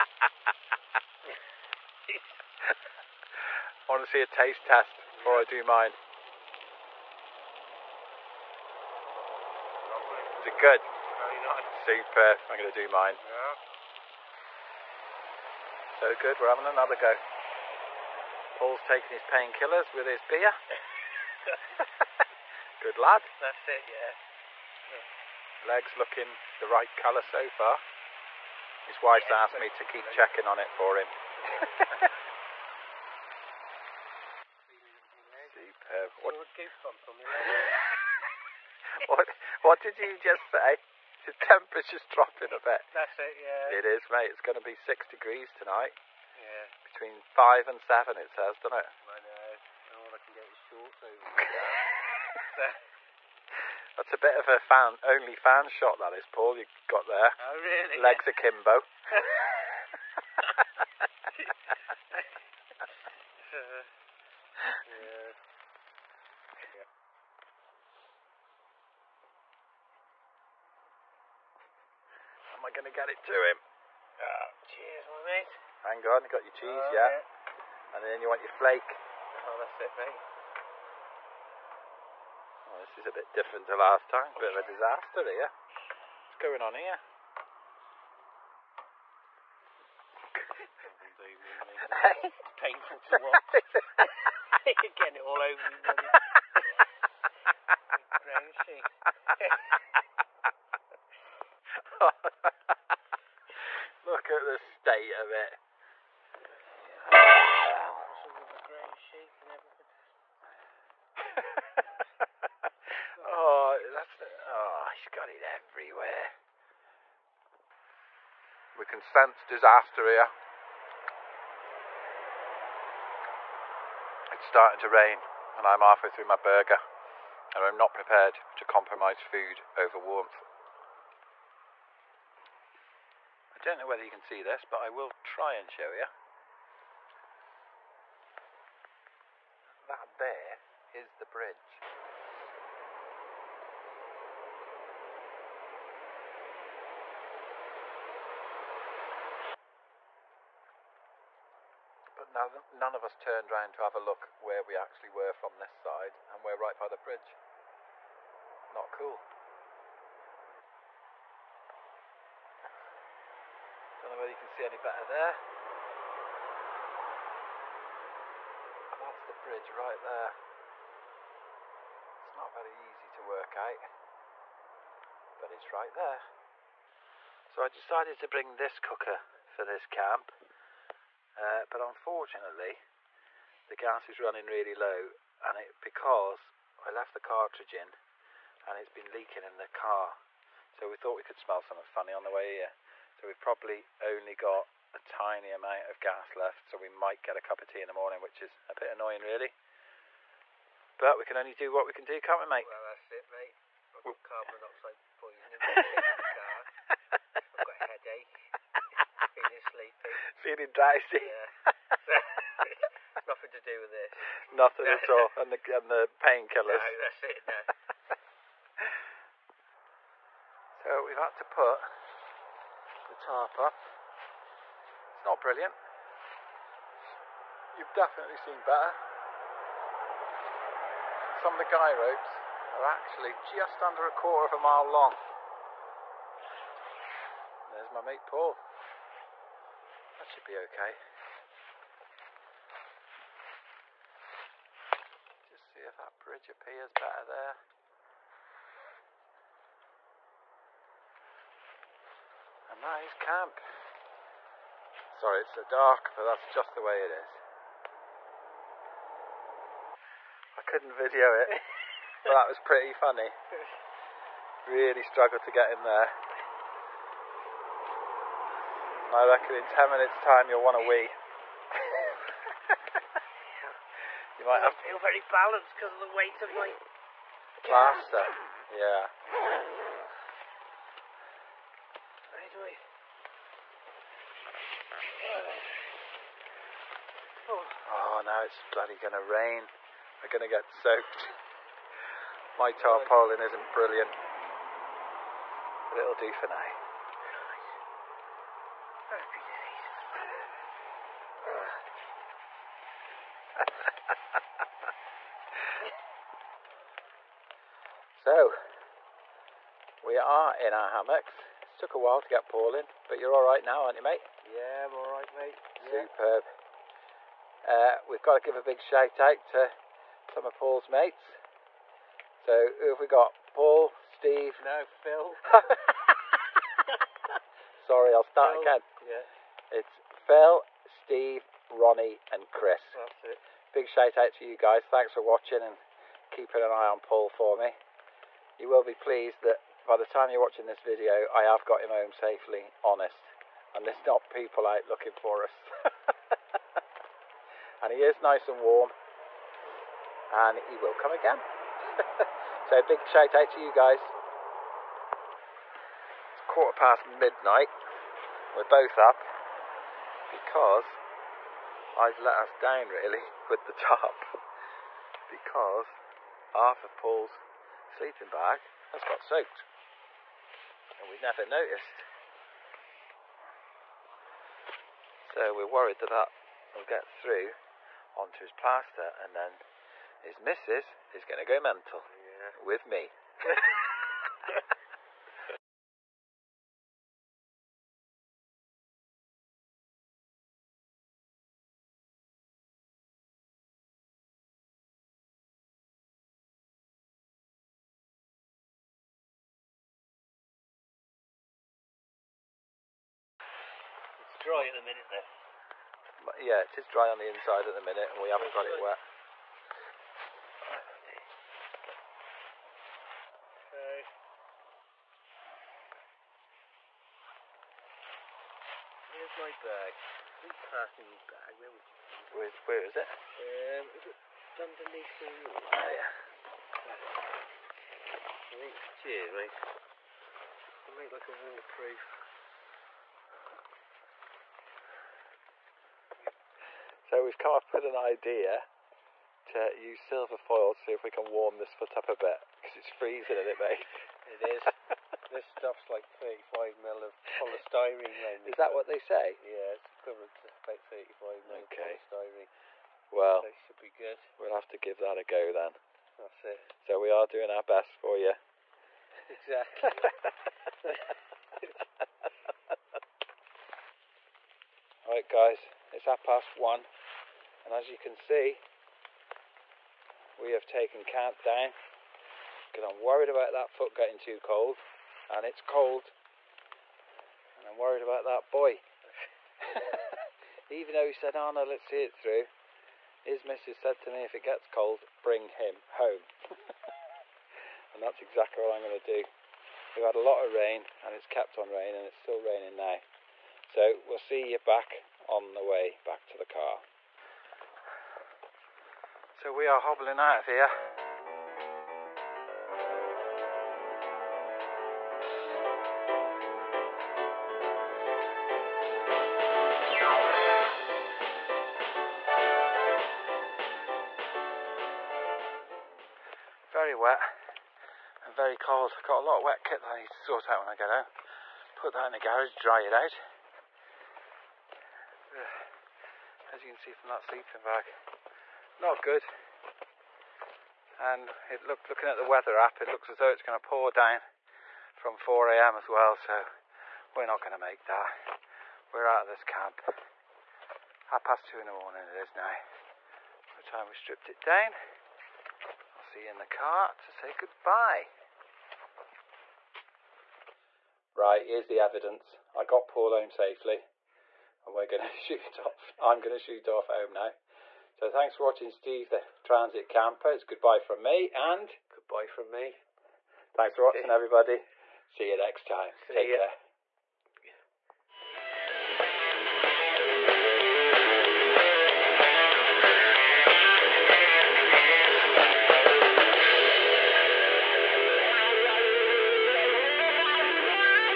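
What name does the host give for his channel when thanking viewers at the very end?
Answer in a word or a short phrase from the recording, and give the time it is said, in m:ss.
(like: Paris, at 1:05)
Steve the Transit Camper, at 9:18.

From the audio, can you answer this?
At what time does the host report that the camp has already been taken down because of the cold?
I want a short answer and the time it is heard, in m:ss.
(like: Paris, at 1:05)
half past one, at 7:46.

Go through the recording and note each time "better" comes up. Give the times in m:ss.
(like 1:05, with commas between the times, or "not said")
2:44, 3:48, 4:06.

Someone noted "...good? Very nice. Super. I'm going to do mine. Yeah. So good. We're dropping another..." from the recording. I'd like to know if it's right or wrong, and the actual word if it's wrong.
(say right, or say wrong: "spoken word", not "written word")
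wrong: "having", not "dropping".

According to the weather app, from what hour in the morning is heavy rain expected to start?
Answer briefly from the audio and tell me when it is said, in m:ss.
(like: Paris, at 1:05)
4 a.m., at 8:55.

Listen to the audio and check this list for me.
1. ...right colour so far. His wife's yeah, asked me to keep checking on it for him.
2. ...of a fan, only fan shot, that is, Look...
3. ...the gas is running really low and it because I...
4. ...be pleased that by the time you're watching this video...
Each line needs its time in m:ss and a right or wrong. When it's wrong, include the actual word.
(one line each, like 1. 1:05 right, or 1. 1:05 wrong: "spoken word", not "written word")
1. 0:26 right
2. 0:54 wrong: "Paul", not "Look"
3. 3:03 right
4. 5:38 right.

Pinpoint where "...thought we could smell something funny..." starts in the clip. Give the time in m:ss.
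3:10.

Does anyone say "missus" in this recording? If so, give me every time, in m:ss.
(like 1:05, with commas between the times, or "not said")
6:20, 8:03.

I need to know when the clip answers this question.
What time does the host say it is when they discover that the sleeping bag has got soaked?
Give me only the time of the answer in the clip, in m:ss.
5:56.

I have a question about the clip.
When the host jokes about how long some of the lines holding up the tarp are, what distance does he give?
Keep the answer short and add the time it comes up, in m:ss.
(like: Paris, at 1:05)
a quarter of a mile, at 3:54.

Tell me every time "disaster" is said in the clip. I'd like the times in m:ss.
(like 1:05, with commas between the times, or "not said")
1:24, 1:59.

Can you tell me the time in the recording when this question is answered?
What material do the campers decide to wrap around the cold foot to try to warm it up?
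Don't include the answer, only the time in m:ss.
7:20.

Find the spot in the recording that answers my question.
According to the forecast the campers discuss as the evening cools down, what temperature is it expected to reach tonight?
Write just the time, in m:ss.
0:44.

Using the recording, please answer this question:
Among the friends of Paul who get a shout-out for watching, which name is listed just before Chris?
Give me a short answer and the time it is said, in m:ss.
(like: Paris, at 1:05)
Ronnie, at 5:31.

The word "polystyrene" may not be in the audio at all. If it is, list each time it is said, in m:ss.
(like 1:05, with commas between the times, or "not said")
7:27, 7:32.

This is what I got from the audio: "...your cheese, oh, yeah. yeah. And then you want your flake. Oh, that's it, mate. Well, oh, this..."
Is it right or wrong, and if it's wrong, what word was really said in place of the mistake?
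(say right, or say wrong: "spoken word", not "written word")
right.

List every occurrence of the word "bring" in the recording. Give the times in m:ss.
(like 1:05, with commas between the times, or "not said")
2:58, 8:05.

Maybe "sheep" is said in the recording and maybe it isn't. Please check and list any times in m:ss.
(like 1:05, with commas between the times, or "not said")
1:38, 1:49.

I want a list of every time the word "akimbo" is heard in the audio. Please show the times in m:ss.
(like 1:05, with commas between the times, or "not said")
0:58.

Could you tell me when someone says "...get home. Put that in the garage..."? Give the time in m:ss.
8:40.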